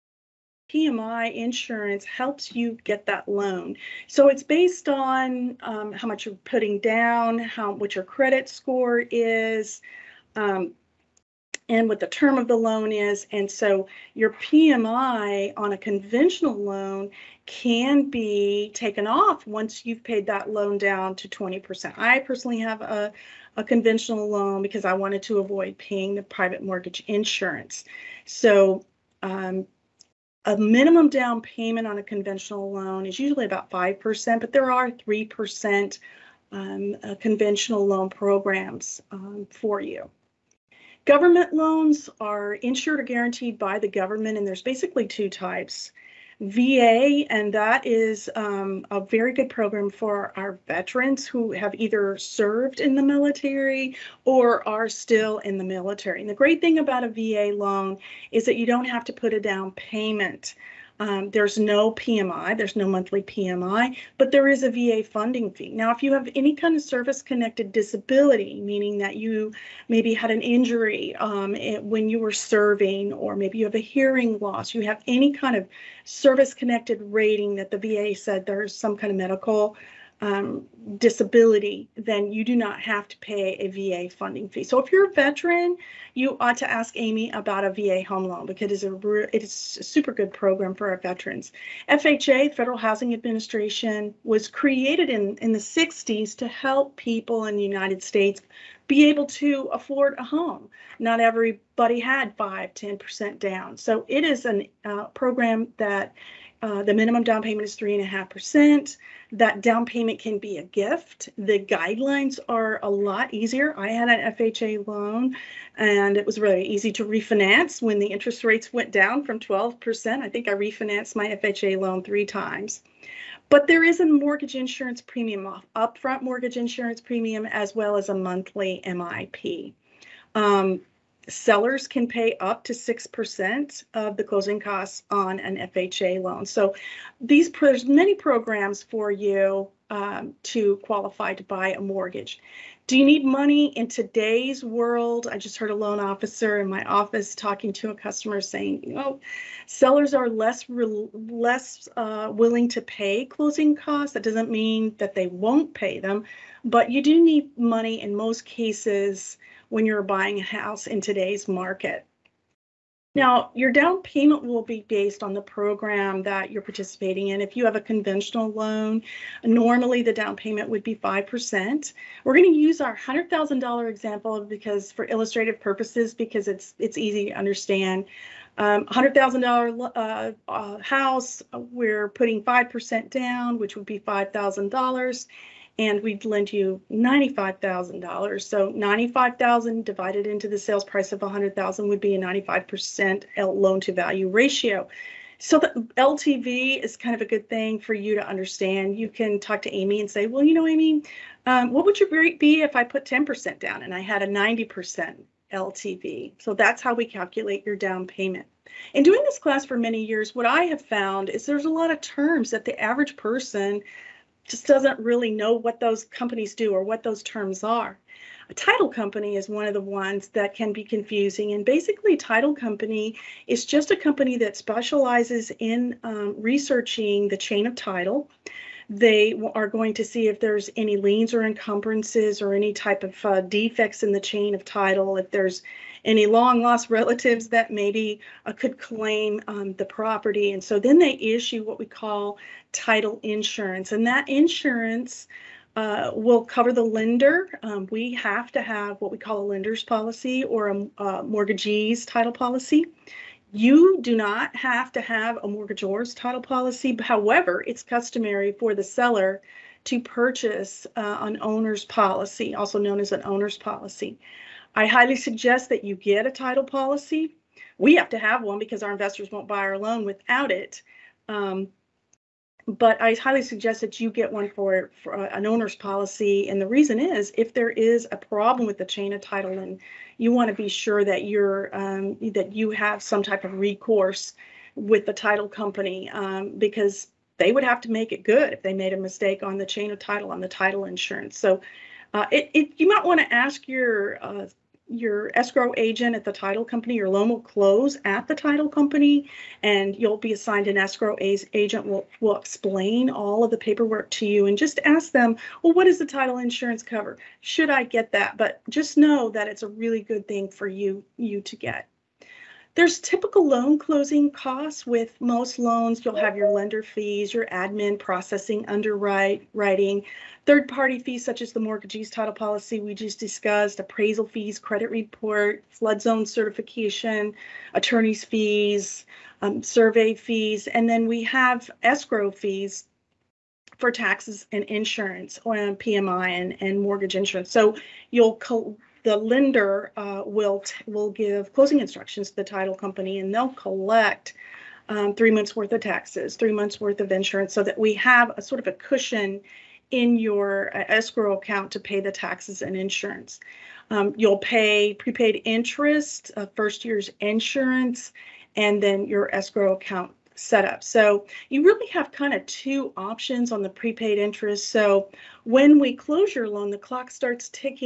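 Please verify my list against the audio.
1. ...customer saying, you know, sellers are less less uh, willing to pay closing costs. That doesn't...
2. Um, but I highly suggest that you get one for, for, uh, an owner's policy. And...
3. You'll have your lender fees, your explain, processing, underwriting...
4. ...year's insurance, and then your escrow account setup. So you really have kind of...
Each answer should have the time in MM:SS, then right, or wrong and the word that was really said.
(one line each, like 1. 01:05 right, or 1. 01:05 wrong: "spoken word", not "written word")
1. 02:27 right
2. 04:31 right
3. 05:16 wrong: "admin", not "explain"
4. 05:56 right.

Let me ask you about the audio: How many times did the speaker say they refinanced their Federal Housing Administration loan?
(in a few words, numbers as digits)
3 times.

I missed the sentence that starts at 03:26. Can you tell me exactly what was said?
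So that's how we calculate your down payment.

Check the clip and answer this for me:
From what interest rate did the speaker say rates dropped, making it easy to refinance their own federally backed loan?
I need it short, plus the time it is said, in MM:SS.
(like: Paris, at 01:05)
12%, at 01:59.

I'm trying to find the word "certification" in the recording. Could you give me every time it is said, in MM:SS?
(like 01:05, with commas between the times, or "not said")
05:26.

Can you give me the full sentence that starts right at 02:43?
Now, your down payment will be based on the program that you're participating in.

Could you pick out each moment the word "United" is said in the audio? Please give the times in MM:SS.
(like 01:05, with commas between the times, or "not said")
01:37.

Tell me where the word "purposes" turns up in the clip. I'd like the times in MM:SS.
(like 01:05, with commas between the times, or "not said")
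02:55.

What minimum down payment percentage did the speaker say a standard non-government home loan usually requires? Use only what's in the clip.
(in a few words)
5%.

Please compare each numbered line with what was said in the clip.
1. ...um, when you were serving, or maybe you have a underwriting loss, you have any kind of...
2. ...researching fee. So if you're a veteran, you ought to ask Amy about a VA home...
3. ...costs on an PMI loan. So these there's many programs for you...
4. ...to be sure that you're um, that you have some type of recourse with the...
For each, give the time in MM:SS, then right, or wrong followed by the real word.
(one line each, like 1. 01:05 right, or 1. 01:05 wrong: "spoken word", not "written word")
1. 01:11 wrong: "hearing", not "underwriting"
2. 01:24 wrong: "funding", not "researching"
3. 02:14 wrong: "FHA", not "PMI"
4. 04:40 right.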